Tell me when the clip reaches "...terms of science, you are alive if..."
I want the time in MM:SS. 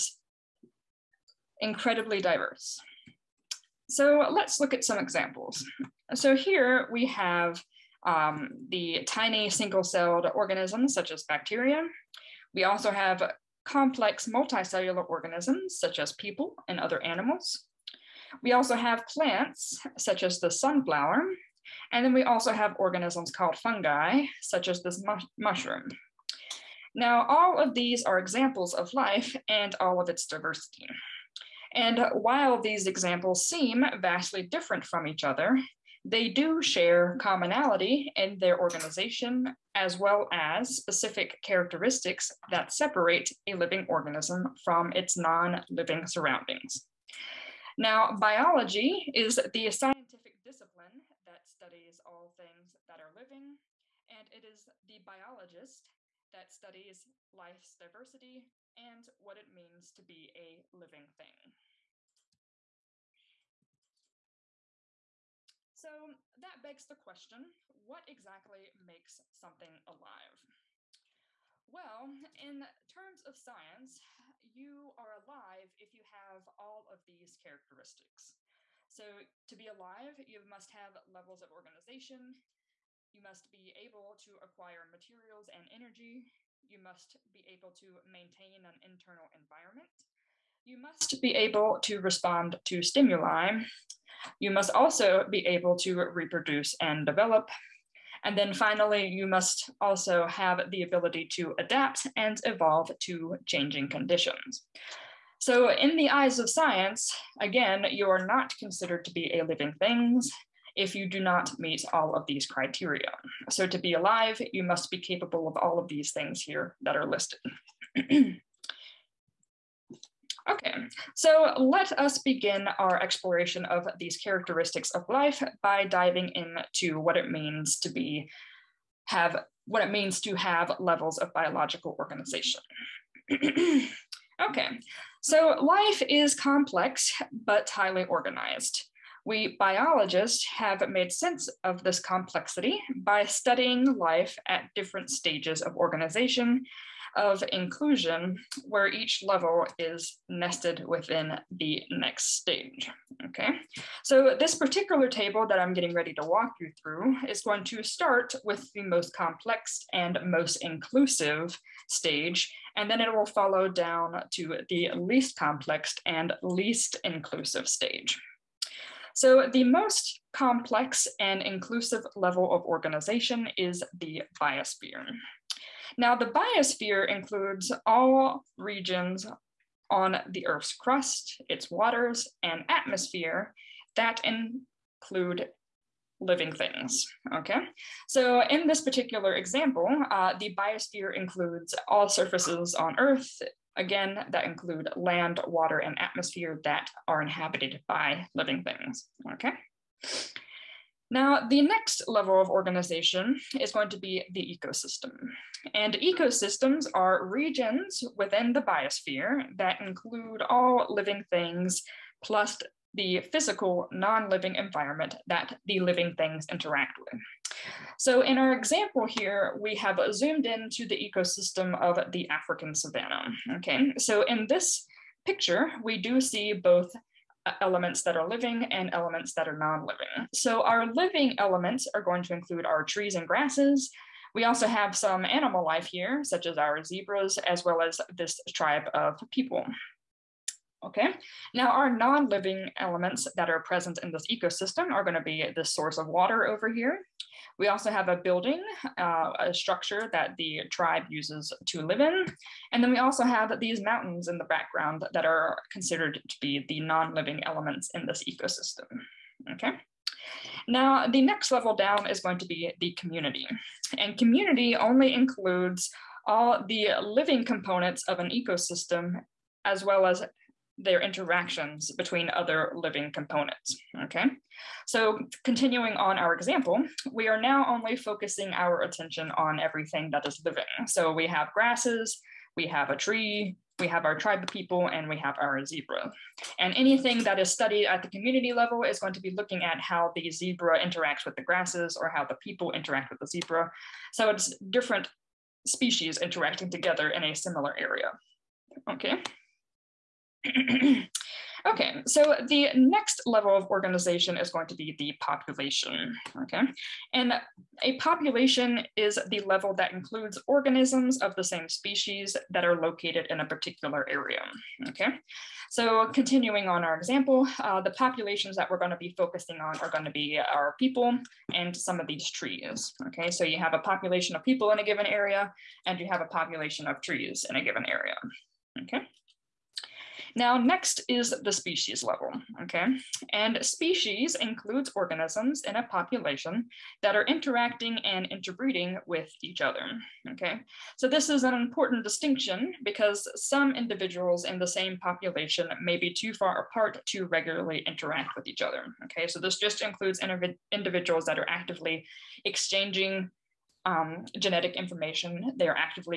01:12.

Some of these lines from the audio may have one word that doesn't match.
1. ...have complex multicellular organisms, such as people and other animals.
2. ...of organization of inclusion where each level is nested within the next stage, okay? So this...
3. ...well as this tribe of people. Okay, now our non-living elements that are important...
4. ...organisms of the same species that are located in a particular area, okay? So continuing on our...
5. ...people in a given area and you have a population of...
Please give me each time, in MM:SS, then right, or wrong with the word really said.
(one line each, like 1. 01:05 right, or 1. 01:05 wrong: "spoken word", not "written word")
1. 00:12 right
2. 02:25 right
3. 03:57 wrong: "present", not "important"
4. 05:10 right
5. 05:24 right.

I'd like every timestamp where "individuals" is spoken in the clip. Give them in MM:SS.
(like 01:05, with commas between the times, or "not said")
05:43, 05:50.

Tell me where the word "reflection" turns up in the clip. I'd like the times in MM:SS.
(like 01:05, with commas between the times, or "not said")
not said.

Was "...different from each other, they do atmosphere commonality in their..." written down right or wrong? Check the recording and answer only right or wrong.
wrong.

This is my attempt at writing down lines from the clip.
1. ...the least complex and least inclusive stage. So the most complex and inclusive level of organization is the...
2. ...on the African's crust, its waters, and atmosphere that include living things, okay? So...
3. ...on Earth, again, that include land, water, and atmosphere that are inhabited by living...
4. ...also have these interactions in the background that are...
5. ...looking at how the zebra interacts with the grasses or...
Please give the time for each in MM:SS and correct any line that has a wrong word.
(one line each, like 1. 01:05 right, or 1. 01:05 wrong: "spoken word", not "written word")
1. 02:44 right
2. 02:59 wrong: "Earth", not "African"
3. 03:12 right
4. 04:12 wrong: "mountains", not "interactions"
5. 04:49 right.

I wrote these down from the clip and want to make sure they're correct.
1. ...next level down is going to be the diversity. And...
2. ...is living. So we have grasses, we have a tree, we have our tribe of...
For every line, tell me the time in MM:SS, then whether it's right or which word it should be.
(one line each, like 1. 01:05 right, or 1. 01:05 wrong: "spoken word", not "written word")
1. 04:21 wrong: "community", not "diversity"
2. 04:40 right.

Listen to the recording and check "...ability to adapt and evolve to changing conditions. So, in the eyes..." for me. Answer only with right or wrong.
right.